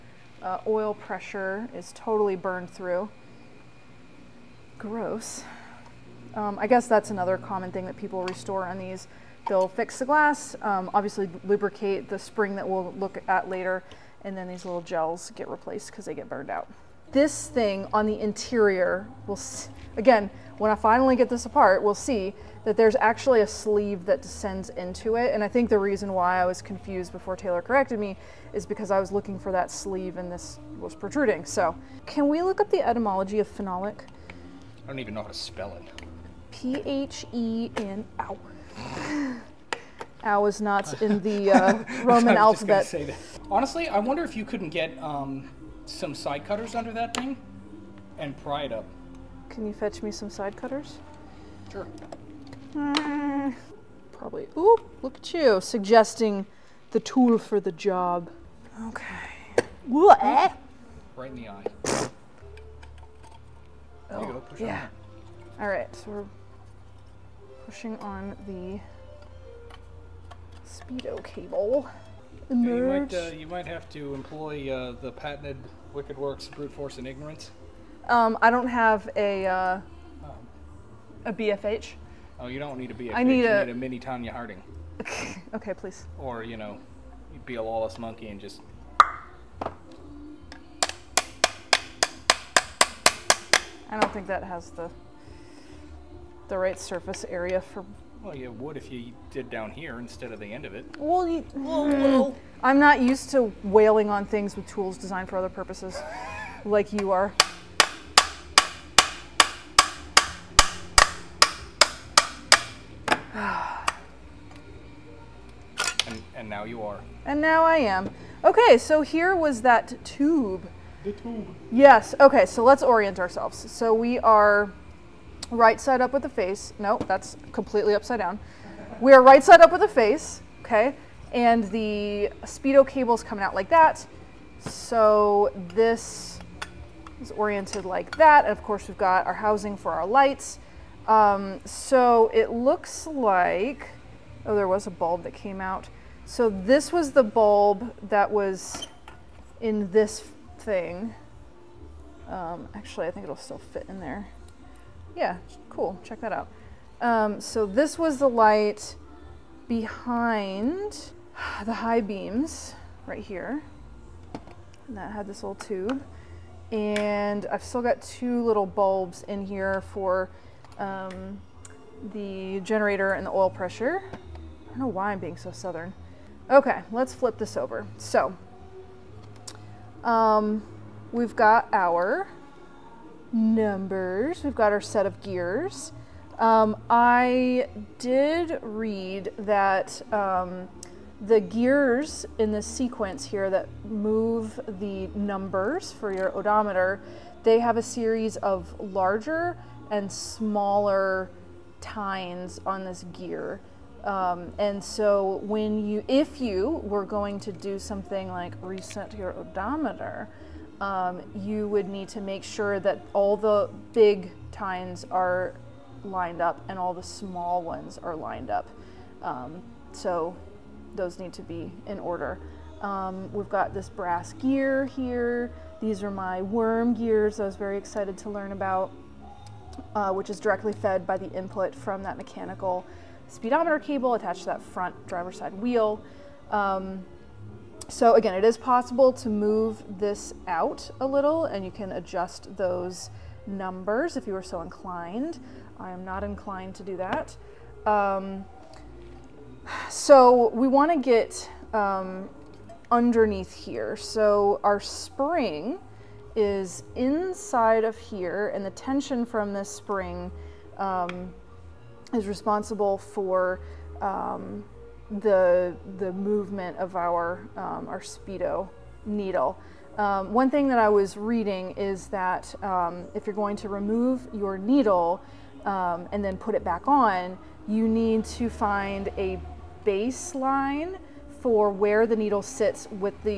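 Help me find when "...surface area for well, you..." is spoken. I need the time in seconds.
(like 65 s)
96 s.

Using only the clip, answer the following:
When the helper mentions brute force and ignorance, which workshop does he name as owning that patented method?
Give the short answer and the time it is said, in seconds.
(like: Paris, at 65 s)
Wicked Werks, at 75 s.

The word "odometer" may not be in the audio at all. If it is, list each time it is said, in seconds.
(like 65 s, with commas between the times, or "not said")
196 s, 209 s.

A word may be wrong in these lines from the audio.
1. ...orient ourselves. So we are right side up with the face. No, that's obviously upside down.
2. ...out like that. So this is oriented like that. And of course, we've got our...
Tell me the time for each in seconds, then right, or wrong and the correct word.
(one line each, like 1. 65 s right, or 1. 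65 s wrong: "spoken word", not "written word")
1. 122 s wrong: "completely", not "obviously"
2. 133 s right.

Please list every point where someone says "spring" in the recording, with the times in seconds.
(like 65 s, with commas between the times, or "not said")
12 s, 254 s, 259 s.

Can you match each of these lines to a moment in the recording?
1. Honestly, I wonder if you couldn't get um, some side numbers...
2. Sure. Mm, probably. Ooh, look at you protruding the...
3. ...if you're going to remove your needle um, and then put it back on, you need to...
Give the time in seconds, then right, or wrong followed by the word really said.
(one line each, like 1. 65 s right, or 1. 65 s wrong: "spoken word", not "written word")
1. 43 s wrong: "cutters", not "numbers"
2. 51 s wrong: "suggesting", not "protruding"
3. 273 s right.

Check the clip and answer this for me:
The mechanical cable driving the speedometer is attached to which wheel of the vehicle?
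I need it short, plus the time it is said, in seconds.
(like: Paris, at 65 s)
front driver side wheel, at 234 s.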